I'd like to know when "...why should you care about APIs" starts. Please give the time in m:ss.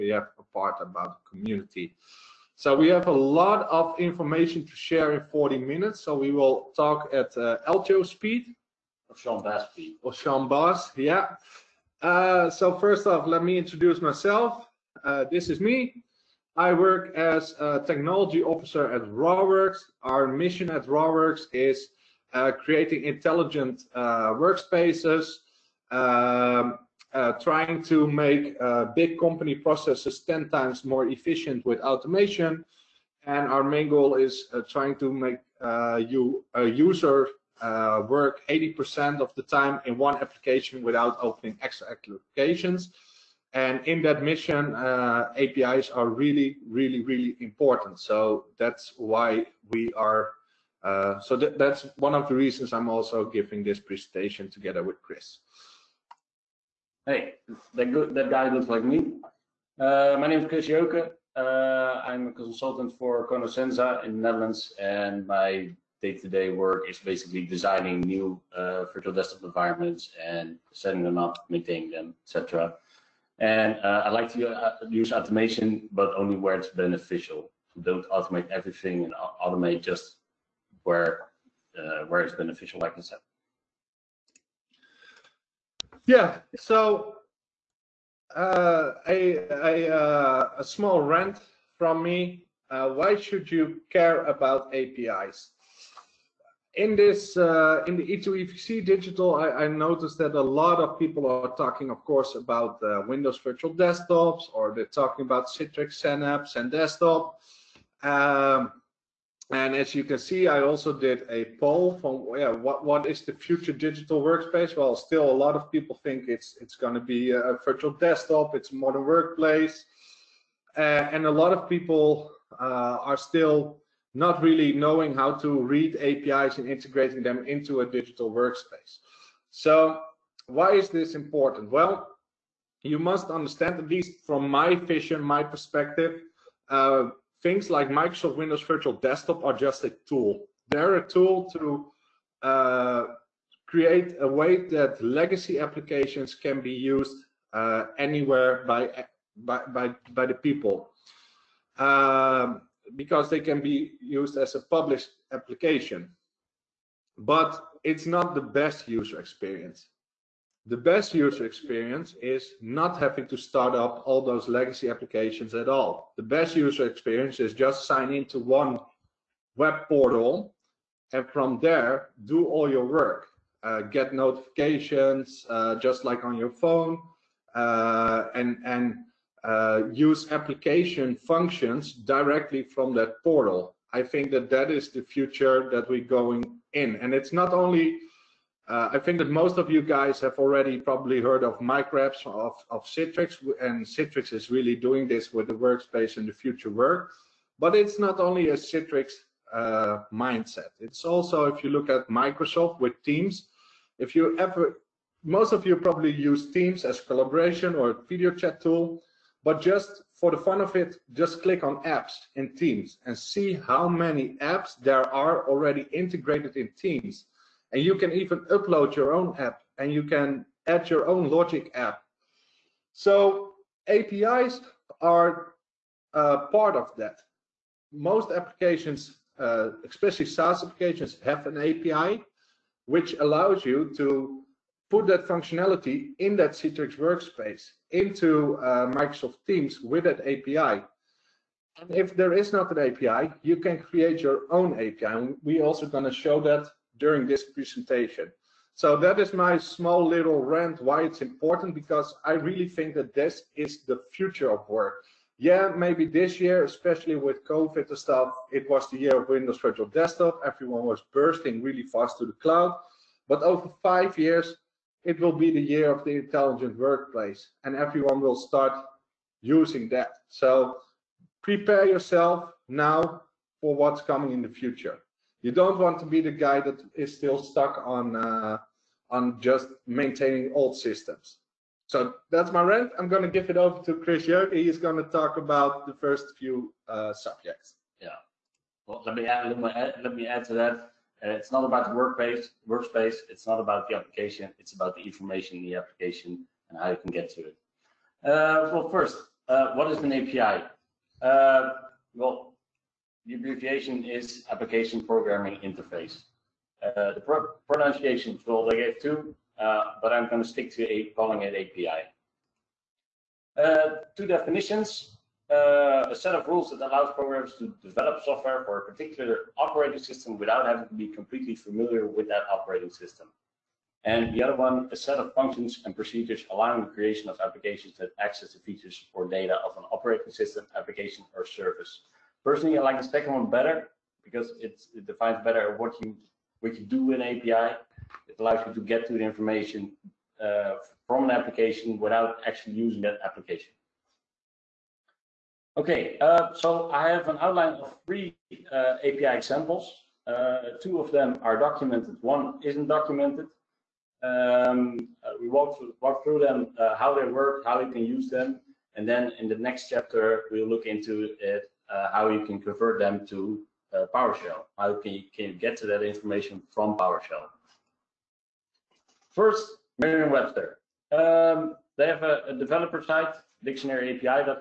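1:32.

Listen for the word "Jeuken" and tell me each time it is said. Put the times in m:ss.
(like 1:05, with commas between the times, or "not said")
1:00, 4:44.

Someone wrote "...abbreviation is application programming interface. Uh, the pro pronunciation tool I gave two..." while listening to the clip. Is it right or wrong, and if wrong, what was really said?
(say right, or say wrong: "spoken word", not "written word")
right.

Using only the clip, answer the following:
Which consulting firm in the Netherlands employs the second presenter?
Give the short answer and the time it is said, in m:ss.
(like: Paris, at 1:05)
Conoscenza, at 1:03.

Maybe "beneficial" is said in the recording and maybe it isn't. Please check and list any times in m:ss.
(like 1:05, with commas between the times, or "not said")
1:16, 1:22.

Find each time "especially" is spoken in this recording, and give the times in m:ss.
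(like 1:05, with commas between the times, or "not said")
3:49, 4:16.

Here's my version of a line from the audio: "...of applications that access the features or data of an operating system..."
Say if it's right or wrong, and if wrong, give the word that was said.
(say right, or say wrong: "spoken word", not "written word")
right.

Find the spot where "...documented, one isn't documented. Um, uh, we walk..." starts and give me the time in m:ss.
5:51.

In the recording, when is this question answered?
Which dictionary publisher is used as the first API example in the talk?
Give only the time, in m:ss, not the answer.
6:09.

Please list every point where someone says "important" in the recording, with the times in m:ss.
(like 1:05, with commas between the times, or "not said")
0:47, 2:11, 4:11.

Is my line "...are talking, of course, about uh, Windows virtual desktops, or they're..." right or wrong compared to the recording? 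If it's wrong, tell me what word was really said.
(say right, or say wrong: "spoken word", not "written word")
right.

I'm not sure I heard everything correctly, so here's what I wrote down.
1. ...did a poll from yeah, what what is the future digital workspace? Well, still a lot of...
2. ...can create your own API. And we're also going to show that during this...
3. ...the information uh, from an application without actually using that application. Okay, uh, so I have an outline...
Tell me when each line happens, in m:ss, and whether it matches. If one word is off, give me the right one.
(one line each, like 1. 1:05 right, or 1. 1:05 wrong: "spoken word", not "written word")
1. 1:50 right
2. 4:03 right
3. 5:39 right.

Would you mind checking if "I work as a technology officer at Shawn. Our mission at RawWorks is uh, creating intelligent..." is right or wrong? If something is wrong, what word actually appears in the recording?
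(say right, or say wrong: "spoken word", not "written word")
wrong: "RawWorks", not "Shawn".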